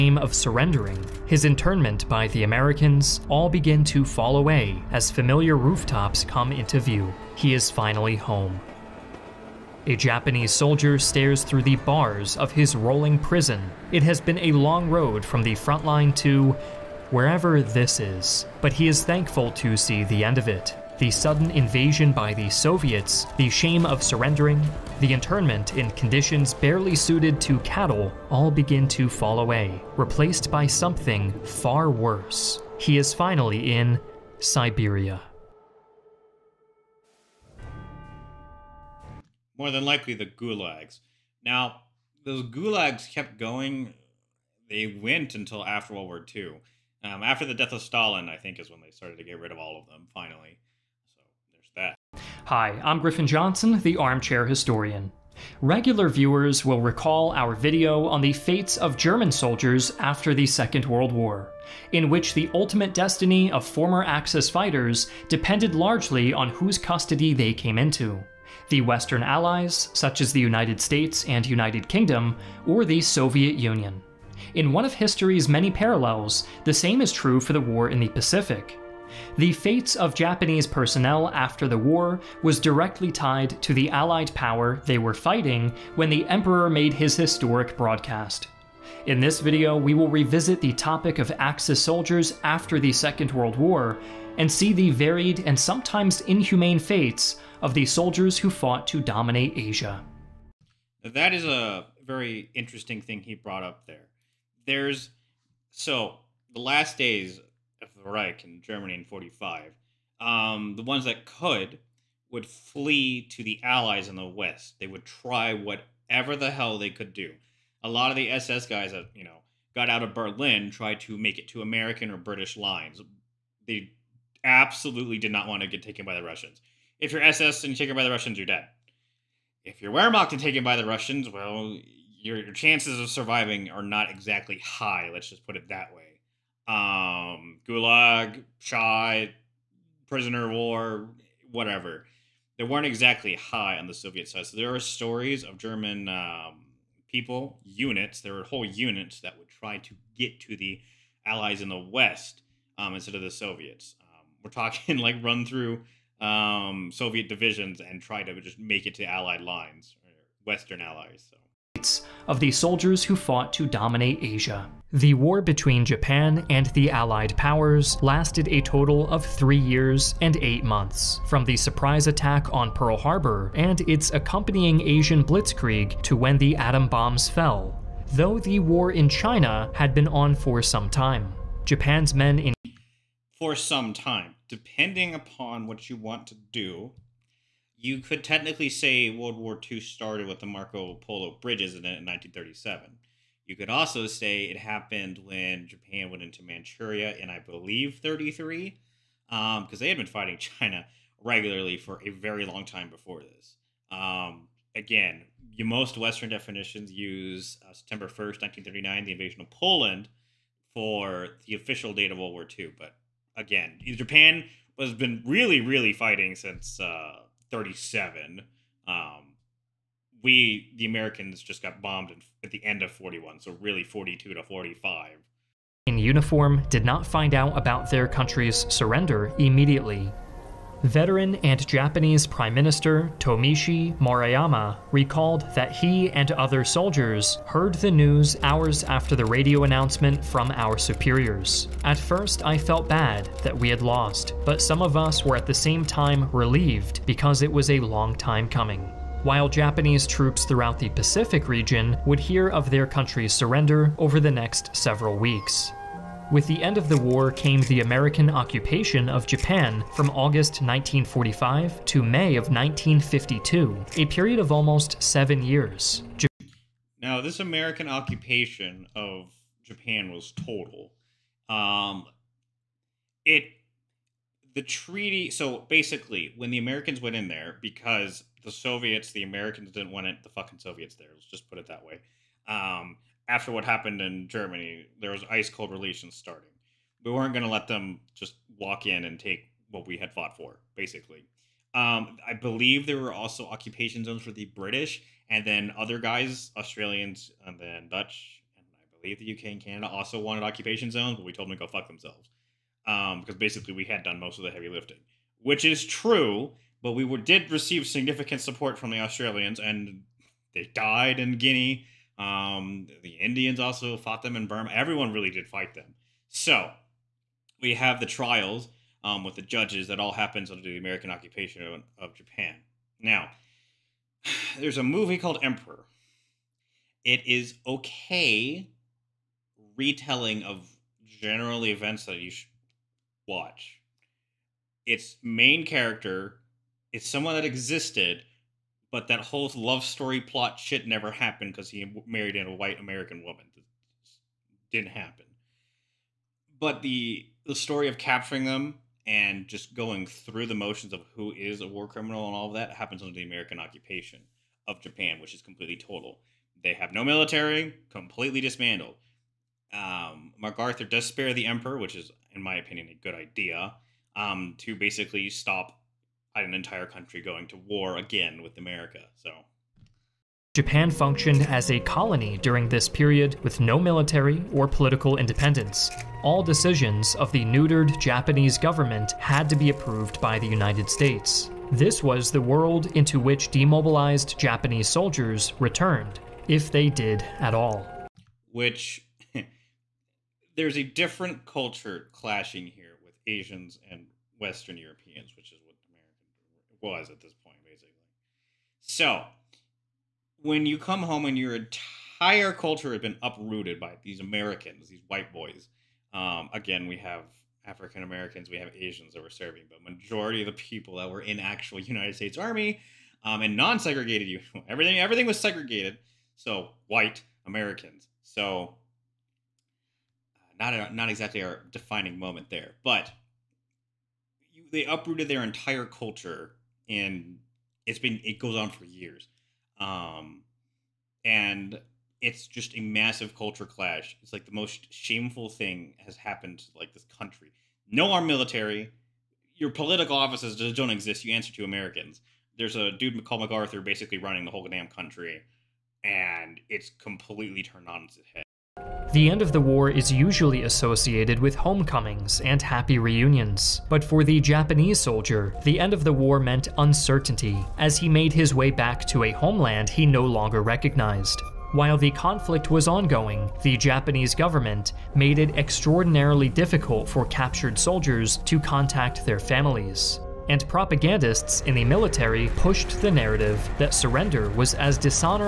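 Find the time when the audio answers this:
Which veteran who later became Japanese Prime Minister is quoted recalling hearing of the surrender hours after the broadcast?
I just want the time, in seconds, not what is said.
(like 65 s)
233 s.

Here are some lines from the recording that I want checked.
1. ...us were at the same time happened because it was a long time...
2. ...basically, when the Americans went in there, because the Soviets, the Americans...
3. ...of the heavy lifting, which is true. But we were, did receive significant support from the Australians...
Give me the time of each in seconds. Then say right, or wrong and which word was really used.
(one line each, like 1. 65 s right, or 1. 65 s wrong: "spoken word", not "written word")
1. 244 s wrong: "relieved", not "happened"
2. 275 s right
3. 304 s right.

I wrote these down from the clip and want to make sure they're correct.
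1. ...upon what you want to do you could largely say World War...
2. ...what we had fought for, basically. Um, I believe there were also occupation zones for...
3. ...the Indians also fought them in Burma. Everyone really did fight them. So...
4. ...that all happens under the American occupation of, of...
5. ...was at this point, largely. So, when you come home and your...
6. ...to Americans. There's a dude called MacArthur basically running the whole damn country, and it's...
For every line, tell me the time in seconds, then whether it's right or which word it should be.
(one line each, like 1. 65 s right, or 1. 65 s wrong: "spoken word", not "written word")
1. 185 s wrong: "technically", not "largely"
2. 289 s right
3. 313 s right
4. 319 s right
5. 396 s wrong: "basically", not "largely"
6. 441 s right.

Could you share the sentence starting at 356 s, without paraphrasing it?
They have no military, completely dismantled.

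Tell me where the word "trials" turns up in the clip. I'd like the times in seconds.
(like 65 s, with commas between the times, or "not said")
318 s.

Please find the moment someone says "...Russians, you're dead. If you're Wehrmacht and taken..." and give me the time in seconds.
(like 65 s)
128 s.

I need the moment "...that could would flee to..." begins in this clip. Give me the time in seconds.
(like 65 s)
111 s.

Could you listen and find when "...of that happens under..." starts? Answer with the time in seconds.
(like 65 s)
352 s.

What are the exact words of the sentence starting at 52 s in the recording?
Hi, I'm Griffin Johnson, the Armchair Historian.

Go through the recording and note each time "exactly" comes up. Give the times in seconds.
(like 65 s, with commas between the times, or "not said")
134 s, 142 s, 421 s.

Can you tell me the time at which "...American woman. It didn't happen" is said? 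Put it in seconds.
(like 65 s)
342 s.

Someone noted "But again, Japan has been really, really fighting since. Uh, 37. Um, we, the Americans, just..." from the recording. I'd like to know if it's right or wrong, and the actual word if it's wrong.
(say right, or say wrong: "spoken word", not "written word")
right.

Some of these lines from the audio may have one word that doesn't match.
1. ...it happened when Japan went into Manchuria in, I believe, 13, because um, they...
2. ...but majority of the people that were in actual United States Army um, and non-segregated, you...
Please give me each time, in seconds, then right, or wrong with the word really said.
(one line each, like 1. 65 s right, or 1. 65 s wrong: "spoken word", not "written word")
1. 194 s wrong: "33", not "13"
2. 409 s right.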